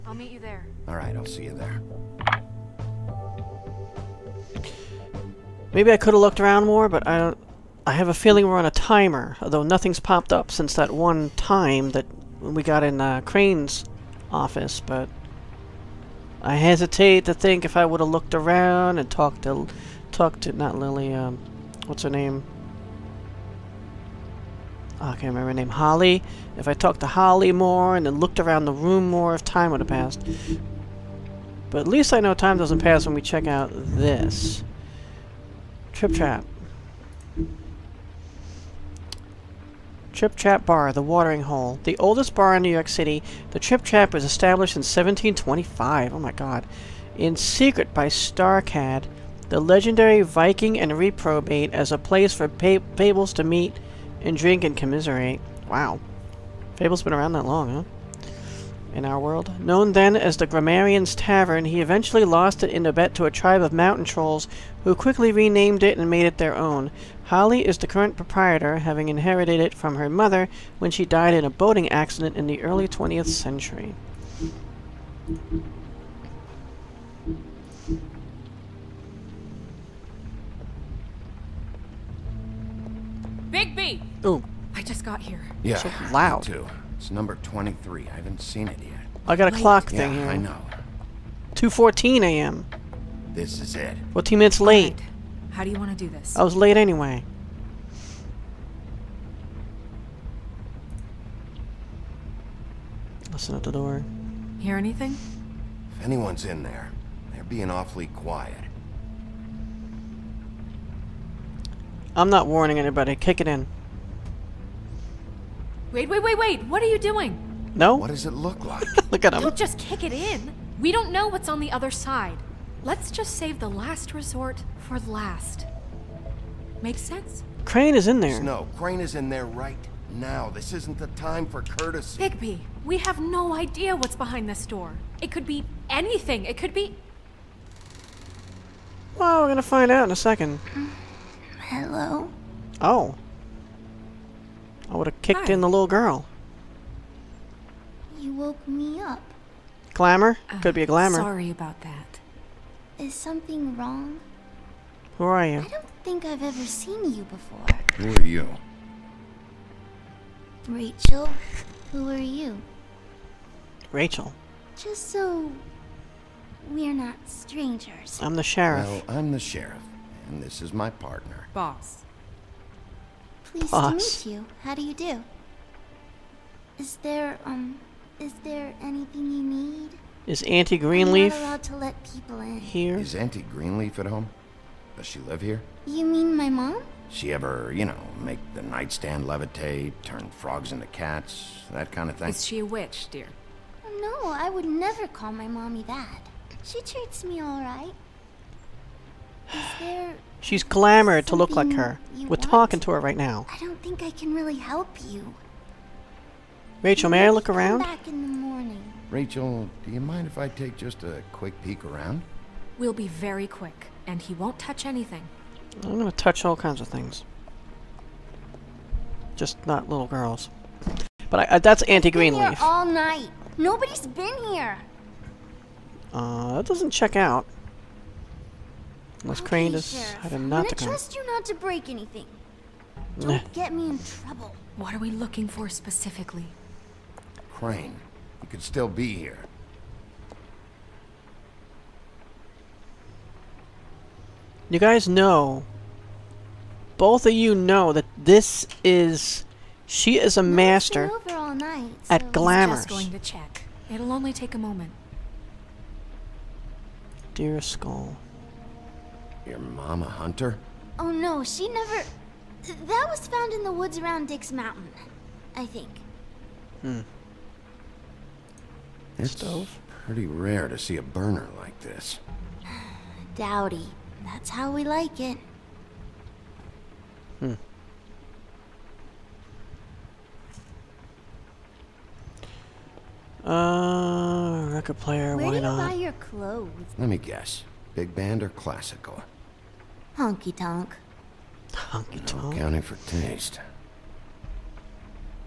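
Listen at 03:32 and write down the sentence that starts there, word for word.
We'll be very quick, and he won't touch anything.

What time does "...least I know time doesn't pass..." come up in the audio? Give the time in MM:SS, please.
00:31.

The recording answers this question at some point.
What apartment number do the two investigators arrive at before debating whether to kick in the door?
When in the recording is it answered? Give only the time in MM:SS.
01:27.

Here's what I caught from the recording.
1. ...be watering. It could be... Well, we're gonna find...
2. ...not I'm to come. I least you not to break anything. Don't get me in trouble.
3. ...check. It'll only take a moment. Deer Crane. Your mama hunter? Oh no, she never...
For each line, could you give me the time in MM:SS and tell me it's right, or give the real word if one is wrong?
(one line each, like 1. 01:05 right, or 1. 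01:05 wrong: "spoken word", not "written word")
1. 02:15 wrong: "anything", not "watering"
2. 03:50 wrong: "trust", not "least"
3. 04:13 wrong: "Skull", not "Crane".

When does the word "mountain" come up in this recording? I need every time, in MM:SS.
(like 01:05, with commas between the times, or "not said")
01:03, 04:24.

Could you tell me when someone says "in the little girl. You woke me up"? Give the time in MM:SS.
02:25.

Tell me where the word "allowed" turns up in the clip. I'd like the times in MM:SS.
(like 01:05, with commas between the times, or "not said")
03:01.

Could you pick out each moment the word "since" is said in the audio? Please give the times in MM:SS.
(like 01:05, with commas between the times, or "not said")
00:10.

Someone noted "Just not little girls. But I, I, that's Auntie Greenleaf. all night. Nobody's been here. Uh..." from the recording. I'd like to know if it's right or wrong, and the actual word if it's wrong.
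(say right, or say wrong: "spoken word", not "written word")
right.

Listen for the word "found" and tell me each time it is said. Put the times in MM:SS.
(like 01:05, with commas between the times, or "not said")
04:23.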